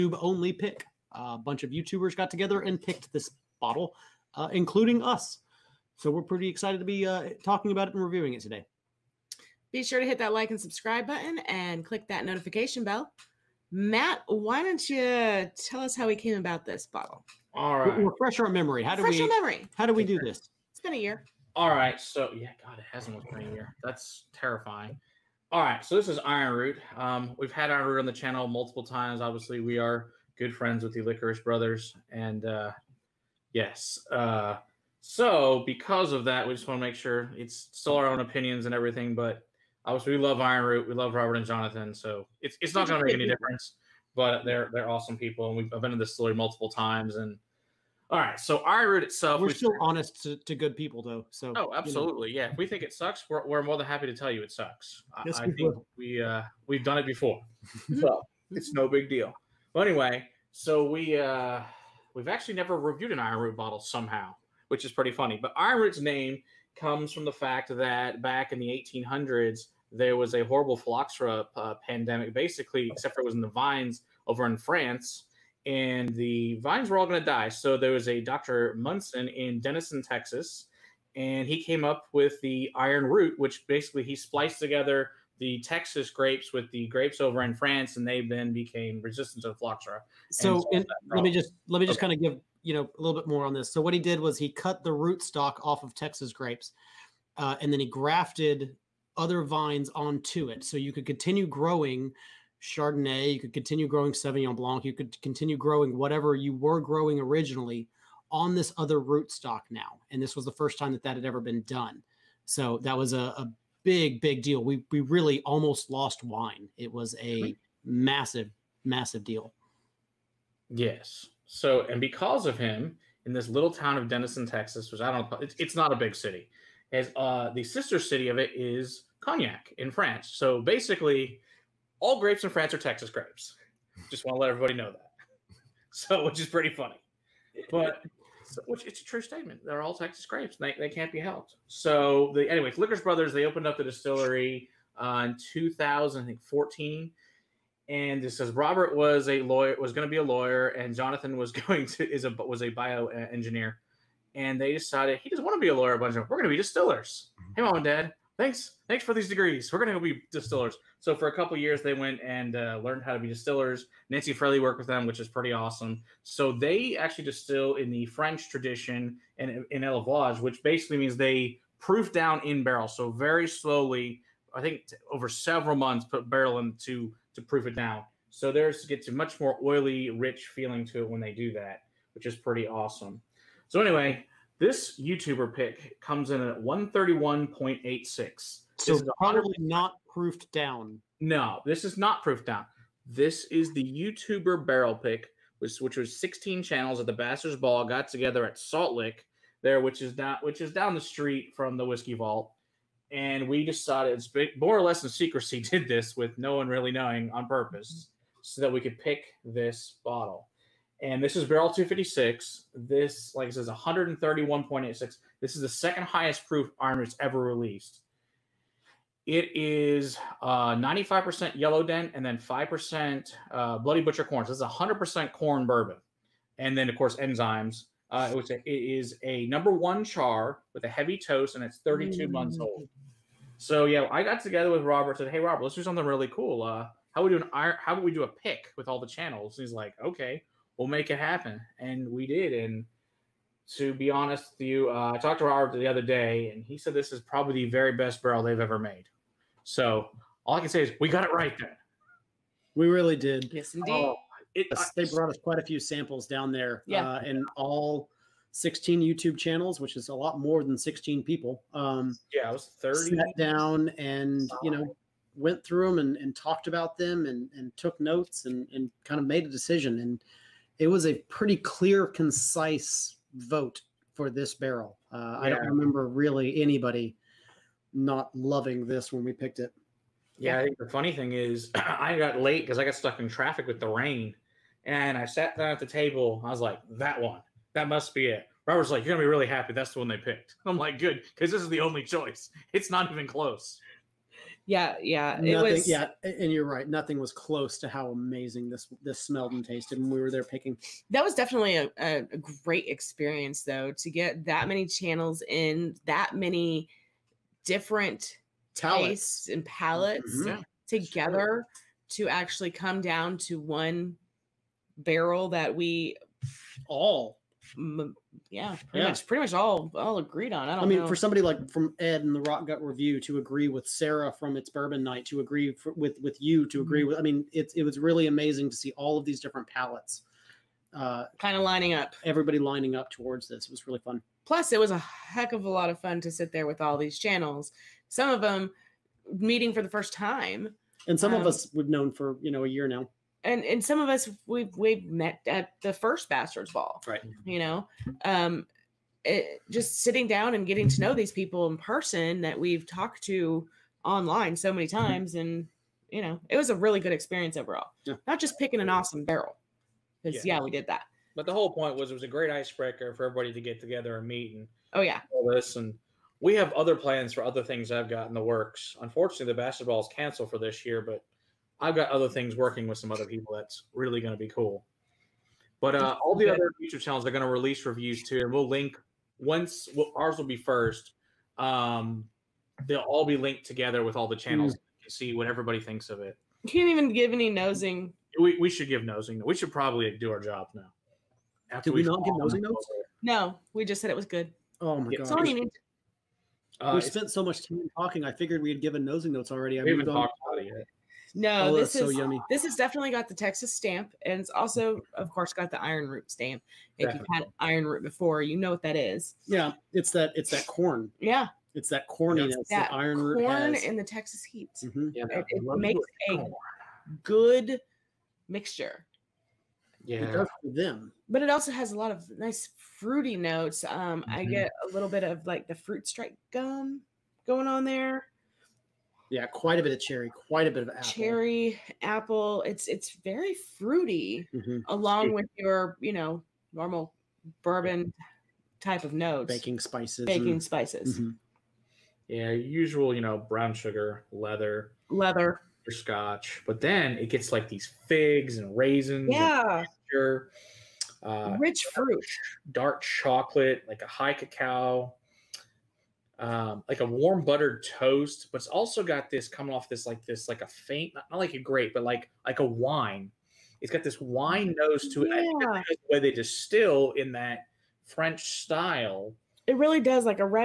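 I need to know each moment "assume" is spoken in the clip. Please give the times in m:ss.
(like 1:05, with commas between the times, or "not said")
not said.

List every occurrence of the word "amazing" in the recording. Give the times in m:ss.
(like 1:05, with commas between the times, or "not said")
4:58, 5:28.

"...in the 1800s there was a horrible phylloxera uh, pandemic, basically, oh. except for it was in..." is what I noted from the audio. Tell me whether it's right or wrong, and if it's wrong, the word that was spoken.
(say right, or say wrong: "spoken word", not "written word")
right.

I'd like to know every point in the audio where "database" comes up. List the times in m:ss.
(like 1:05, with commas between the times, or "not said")
not said.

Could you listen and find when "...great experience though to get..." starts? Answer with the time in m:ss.
5:02.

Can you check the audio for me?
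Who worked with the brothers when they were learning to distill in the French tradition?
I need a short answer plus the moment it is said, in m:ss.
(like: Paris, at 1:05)
Nancy Fraley, at 2:44.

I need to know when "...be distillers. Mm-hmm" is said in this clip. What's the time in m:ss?
2:36.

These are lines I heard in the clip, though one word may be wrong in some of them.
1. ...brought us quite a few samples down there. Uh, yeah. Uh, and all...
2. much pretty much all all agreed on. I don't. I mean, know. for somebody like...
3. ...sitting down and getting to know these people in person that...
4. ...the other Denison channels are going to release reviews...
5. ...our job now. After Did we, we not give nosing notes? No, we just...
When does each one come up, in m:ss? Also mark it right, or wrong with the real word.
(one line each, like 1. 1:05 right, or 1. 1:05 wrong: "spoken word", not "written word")
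1. 4:15 right
2. 5:19 right
3. 5:50 right
4. 6:16 wrong: "YouTube", not "Denison"
5. 6:30 right.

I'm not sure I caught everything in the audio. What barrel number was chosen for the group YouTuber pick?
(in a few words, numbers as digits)
256.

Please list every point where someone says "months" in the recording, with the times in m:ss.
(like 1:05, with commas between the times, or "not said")
2:55, 3:52.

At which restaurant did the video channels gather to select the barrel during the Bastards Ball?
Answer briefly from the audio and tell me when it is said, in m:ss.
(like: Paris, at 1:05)
Salt Lick, at 3:18.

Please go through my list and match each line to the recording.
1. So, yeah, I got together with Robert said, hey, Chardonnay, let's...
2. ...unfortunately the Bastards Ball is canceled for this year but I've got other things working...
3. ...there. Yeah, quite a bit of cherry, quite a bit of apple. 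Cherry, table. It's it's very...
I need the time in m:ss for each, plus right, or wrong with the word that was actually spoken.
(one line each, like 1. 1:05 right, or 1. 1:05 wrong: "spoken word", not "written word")
1. 3:53 wrong: "Robert", not "Chardonnay"
2. 6:09 right
3. 7:07 wrong: "apple", not "table".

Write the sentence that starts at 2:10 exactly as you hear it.
So basically, all grapes in France are Texas grapes.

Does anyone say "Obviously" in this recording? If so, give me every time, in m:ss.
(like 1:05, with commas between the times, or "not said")
0:29, 0:39.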